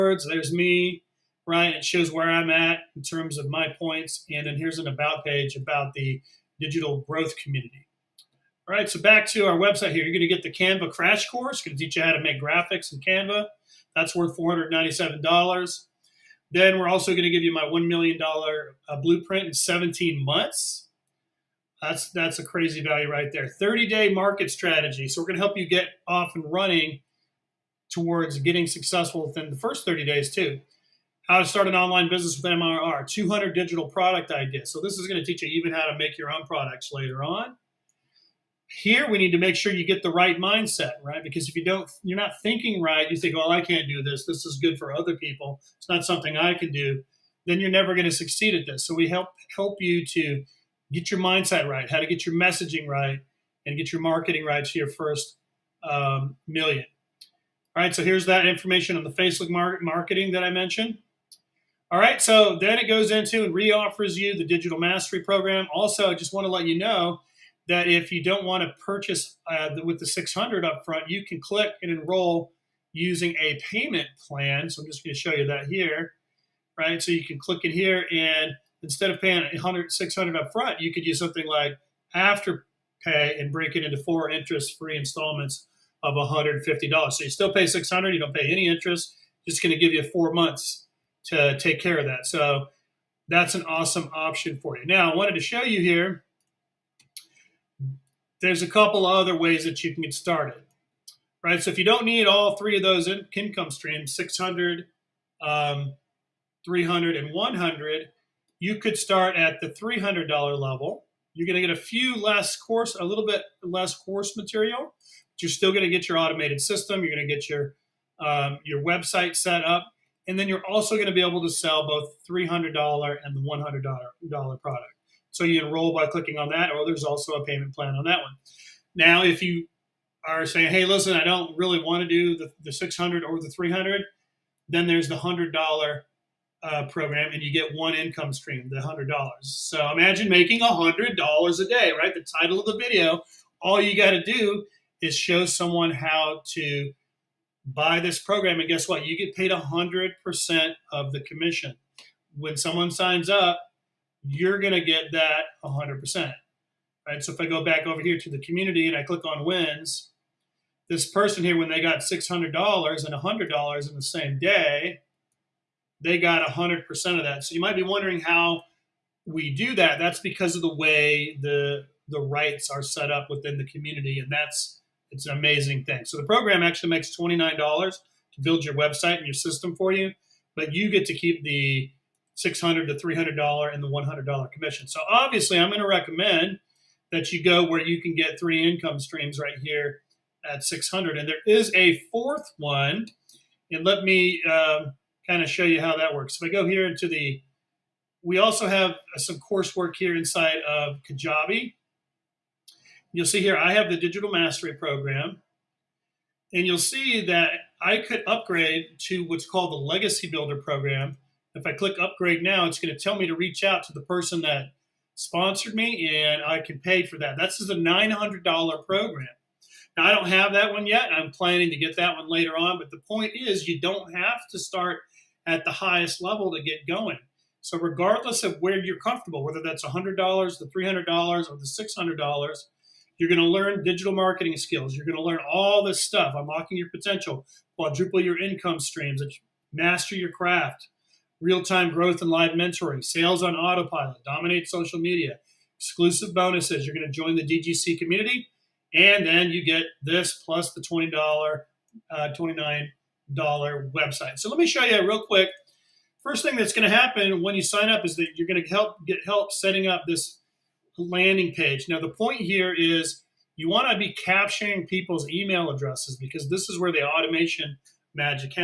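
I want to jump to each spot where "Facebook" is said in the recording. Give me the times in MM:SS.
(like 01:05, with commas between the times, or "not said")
00:59.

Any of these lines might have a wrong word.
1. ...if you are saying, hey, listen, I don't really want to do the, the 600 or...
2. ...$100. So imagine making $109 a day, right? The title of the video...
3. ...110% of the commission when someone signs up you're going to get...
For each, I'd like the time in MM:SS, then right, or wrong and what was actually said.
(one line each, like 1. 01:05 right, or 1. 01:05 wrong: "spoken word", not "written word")
1. 02:09 right
2. 02:18 wrong: "100", not "109"
3. 02:29 wrong: "100", not "110".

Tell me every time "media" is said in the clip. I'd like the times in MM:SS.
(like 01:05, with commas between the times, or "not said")
04:04.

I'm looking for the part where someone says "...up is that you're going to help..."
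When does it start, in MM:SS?
04:17.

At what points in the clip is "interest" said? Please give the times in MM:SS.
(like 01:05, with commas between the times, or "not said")
01:24, 01:28.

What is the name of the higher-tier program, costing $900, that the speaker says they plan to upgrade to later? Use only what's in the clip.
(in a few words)
Legacy Builder program.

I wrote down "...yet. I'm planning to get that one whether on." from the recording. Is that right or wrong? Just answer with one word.
wrong.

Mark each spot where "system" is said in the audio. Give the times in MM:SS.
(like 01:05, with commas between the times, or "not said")
01:56, 02:59.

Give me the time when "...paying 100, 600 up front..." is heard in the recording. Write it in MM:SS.
01:19.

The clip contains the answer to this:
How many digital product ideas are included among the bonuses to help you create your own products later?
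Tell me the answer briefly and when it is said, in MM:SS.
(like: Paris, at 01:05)
200, at 00:33.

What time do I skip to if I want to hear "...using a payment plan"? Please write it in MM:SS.
01:12.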